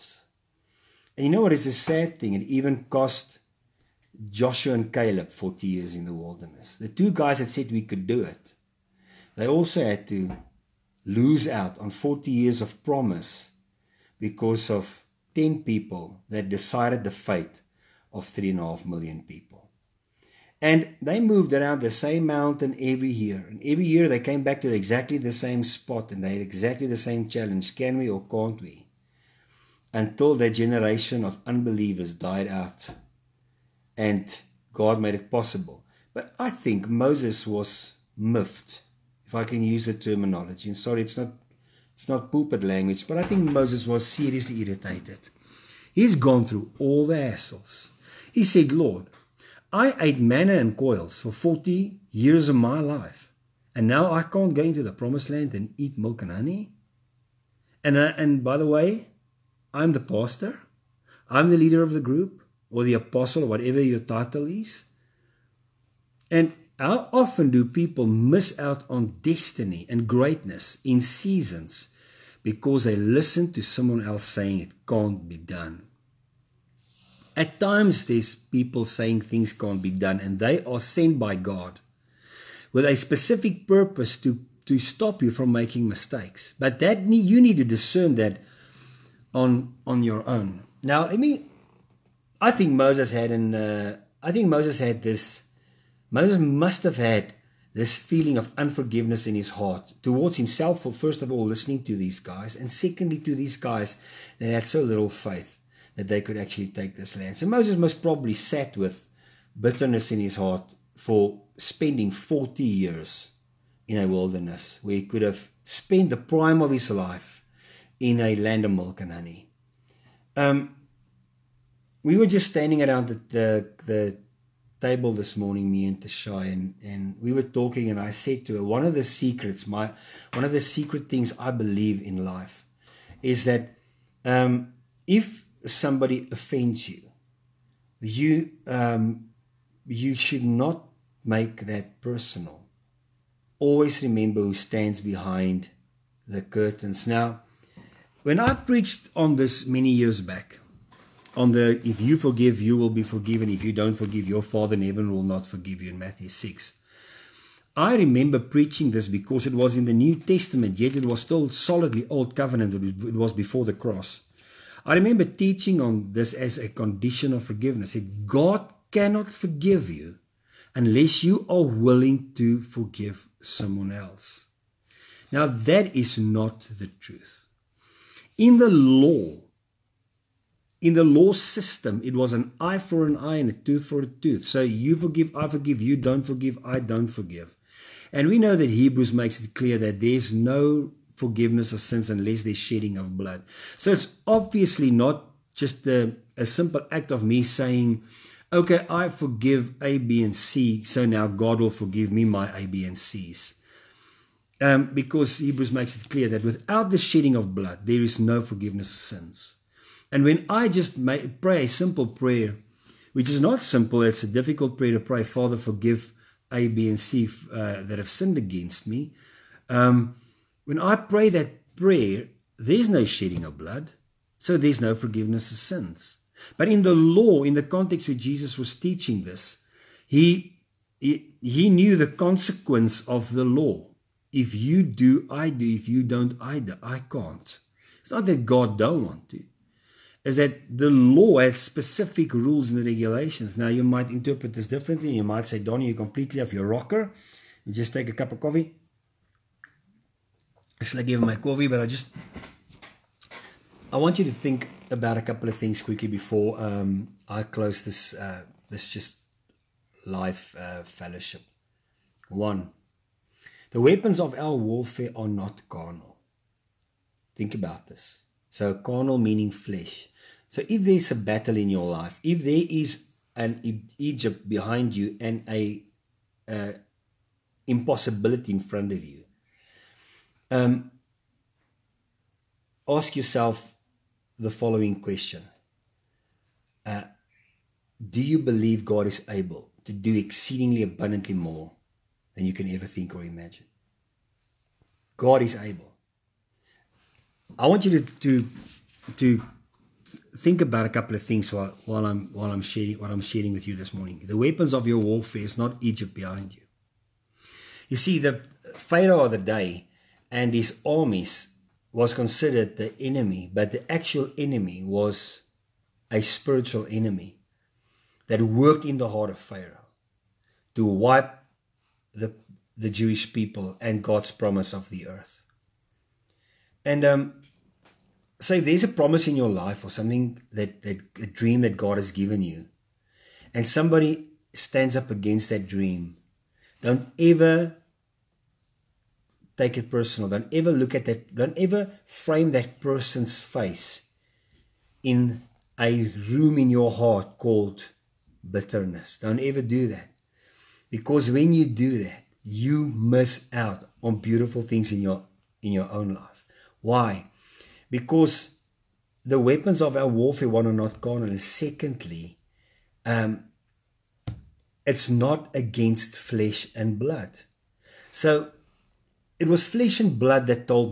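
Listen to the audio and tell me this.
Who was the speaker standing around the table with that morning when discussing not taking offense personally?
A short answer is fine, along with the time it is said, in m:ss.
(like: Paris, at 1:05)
Tashai, at 2:05.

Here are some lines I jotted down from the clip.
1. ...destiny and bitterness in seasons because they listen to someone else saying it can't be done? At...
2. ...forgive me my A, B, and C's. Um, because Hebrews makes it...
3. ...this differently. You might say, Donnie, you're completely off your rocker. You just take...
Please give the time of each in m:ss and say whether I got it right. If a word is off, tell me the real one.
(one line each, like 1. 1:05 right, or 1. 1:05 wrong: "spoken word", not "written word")
1. 1:09 wrong: "greatness", not "bitterness"
2. 3:21 right
3. 4:04 right.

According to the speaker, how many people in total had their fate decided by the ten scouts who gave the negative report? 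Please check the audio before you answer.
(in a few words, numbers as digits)
3.5 million.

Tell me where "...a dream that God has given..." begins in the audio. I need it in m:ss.
5:31.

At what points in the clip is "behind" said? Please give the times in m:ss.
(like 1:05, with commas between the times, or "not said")
2:24, 4:34, 5:06.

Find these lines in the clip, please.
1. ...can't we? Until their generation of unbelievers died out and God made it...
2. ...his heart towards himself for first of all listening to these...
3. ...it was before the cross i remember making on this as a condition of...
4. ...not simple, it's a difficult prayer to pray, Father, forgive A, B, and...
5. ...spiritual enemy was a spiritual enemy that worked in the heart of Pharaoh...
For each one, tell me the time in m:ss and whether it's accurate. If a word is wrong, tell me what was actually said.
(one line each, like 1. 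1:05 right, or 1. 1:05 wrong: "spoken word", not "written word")
1. 0:28 right
2. 1:39 right
3. 2:42 wrong: "teaching", not "making"
4. 3:33 right
5. 5:13 wrong: "actual", not "spiritual".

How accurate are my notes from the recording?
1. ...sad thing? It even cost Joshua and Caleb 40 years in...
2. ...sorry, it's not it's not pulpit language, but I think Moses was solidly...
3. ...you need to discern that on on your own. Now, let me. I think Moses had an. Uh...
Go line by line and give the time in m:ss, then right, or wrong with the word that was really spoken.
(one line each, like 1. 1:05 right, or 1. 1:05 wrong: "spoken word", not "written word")
1. 0:01 right
2. 0:40 wrong: "seriously", not "solidly"
3. 1:27 right.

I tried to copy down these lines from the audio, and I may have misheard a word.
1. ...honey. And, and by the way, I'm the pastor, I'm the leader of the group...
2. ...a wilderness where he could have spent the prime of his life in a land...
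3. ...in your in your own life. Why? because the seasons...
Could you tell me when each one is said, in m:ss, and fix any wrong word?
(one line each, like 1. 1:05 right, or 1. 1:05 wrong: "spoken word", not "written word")
1. 0:56 right
2. 1:53 right
3. 5:54 wrong: "weapons", not "seasons".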